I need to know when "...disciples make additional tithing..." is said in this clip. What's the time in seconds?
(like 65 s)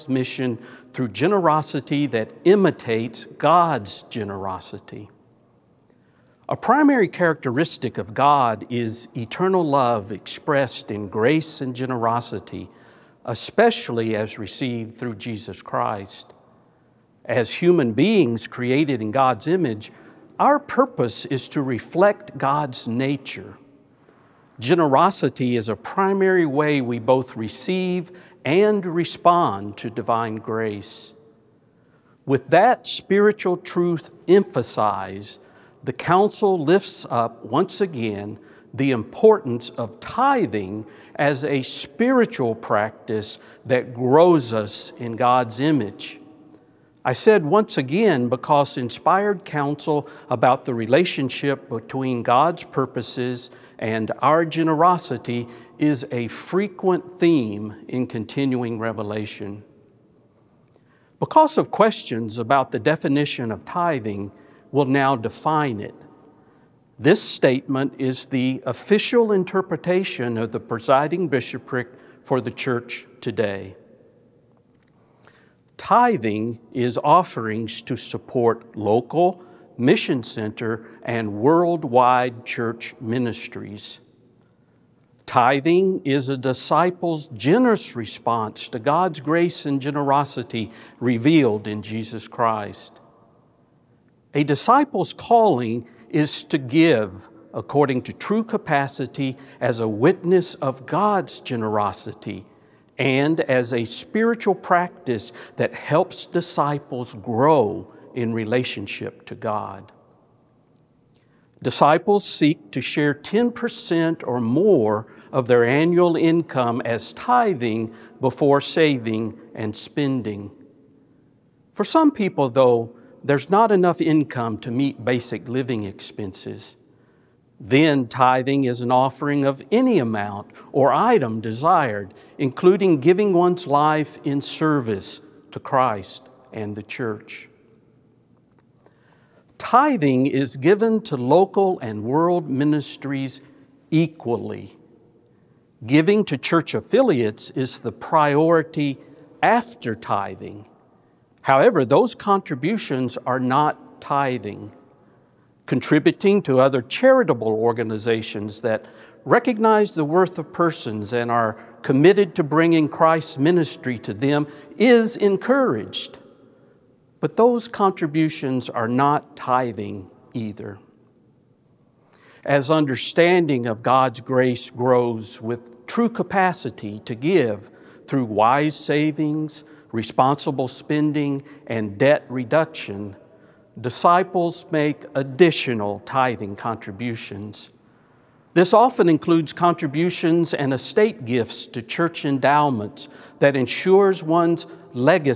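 183 s.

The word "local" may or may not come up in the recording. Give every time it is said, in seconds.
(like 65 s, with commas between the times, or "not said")
78 s, 141 s.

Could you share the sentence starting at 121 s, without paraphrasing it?
For some people, though, there's not enough income to meet basic living expenses.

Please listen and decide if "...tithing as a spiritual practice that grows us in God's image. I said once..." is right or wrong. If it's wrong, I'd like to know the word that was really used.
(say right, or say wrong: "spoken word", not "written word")
right.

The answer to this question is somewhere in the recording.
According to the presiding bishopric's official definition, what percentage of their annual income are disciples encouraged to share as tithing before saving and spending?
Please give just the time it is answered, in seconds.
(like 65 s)
113 s.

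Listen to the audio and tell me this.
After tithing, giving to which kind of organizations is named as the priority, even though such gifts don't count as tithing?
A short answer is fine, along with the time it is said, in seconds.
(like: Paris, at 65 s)
Church affiliates, at 146 s.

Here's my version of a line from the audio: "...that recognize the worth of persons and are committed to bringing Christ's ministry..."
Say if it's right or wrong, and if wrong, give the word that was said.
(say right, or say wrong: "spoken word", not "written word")
right.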